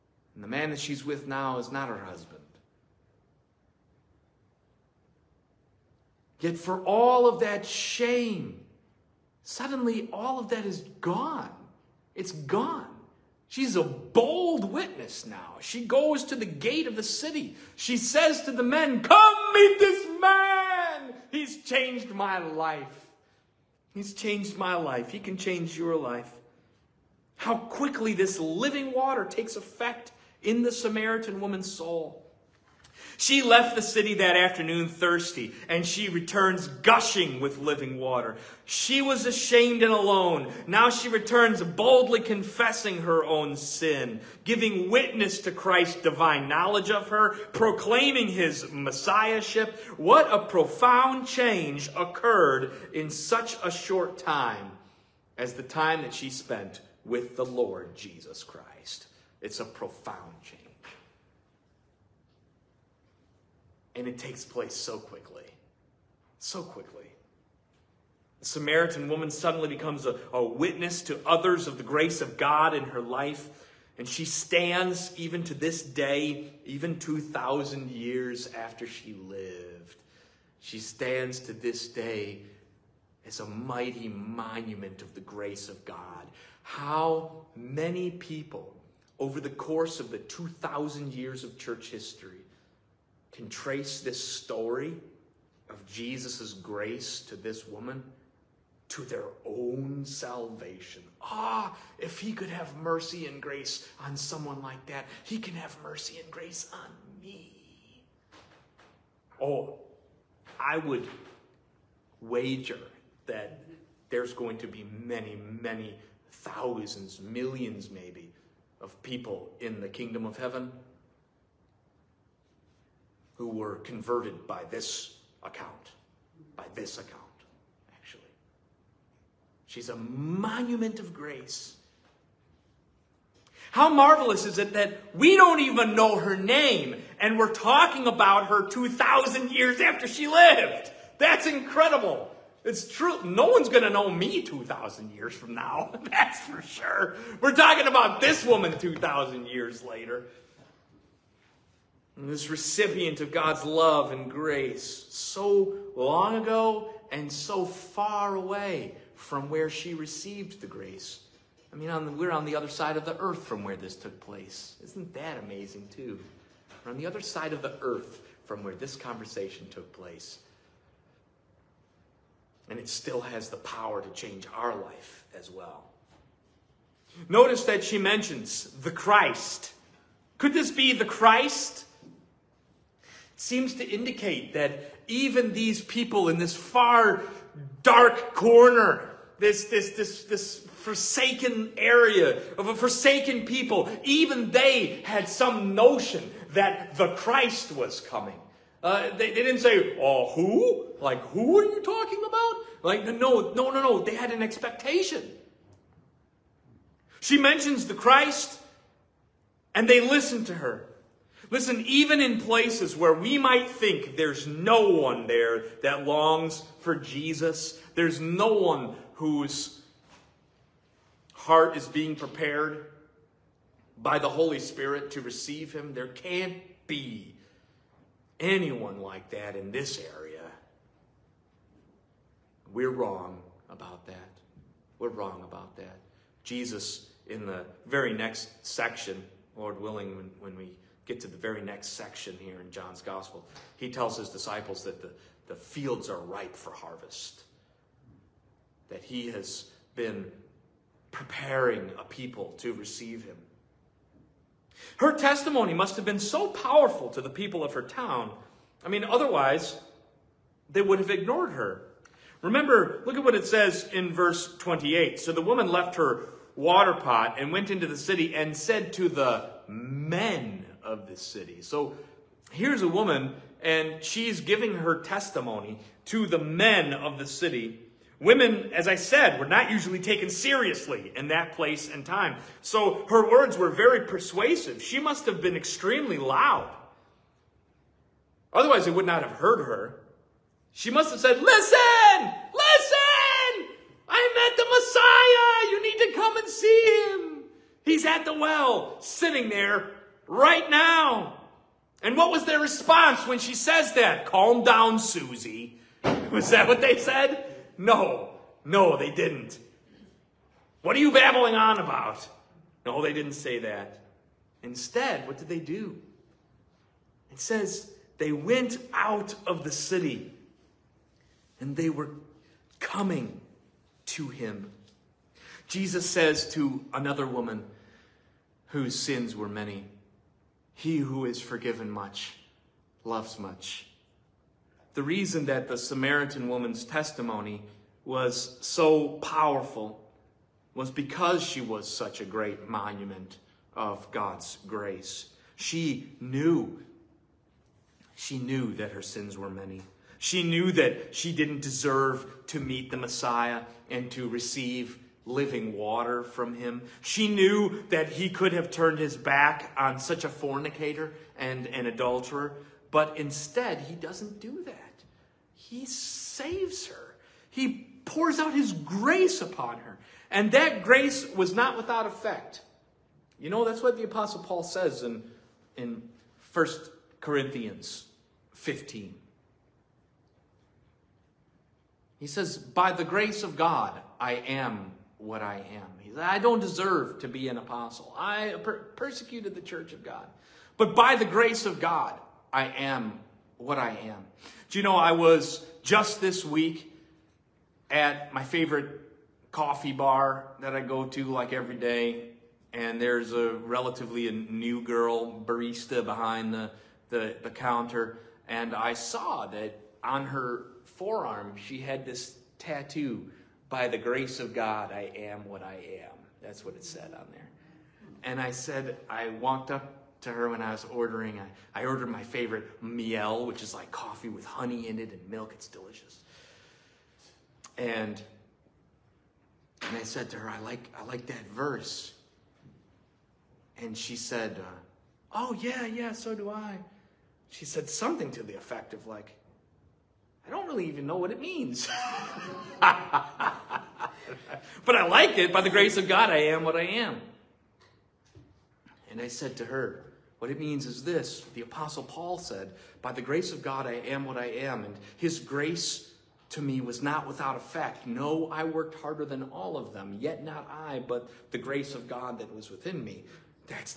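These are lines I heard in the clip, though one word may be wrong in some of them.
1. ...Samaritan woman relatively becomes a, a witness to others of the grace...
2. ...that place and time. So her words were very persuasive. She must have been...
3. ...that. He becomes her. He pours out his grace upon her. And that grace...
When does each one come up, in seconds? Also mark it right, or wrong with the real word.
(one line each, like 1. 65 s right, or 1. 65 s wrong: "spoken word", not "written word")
1. 68 s wrong: "suddenly", not "relatively"
2. 281 s right
3. 364 s wrong: "saves", not "becomes".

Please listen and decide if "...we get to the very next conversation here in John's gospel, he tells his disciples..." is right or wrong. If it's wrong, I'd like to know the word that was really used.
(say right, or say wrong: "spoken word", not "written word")
wrong: "section", not "conversation".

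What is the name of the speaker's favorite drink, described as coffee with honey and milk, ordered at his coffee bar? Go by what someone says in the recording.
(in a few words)
Miel.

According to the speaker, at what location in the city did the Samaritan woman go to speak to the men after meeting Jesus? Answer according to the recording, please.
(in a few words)
The gate.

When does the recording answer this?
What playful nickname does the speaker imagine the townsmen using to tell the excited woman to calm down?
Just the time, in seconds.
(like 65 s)
304 s.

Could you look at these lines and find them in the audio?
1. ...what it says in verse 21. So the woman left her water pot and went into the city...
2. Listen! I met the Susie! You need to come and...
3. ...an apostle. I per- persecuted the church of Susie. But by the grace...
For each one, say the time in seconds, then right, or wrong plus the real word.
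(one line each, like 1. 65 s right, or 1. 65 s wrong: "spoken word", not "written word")
1. 263 s wrong: "28", not "21"
2. 292 s wrong: "Messiah", not "Susie"
3. 387 s wrong: "God", not "Susie".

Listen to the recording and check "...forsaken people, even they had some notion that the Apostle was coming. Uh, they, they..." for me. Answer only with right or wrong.
wrong.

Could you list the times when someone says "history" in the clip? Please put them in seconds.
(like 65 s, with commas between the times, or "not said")
91 s.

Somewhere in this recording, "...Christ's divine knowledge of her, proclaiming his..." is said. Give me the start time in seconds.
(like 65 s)
45 s.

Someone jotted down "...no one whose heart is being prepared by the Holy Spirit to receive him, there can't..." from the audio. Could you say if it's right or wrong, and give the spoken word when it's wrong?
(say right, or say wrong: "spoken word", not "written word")
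right.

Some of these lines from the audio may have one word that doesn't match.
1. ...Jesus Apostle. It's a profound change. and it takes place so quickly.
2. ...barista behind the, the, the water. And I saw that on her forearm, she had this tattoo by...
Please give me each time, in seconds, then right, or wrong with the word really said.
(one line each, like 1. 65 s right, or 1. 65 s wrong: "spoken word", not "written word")
1. 57 s wrong: "Christ", not "Apostle"
2. 405 s wrong: "counter", not "water".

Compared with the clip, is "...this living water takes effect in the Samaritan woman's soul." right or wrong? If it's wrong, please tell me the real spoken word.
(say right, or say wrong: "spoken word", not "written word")
right.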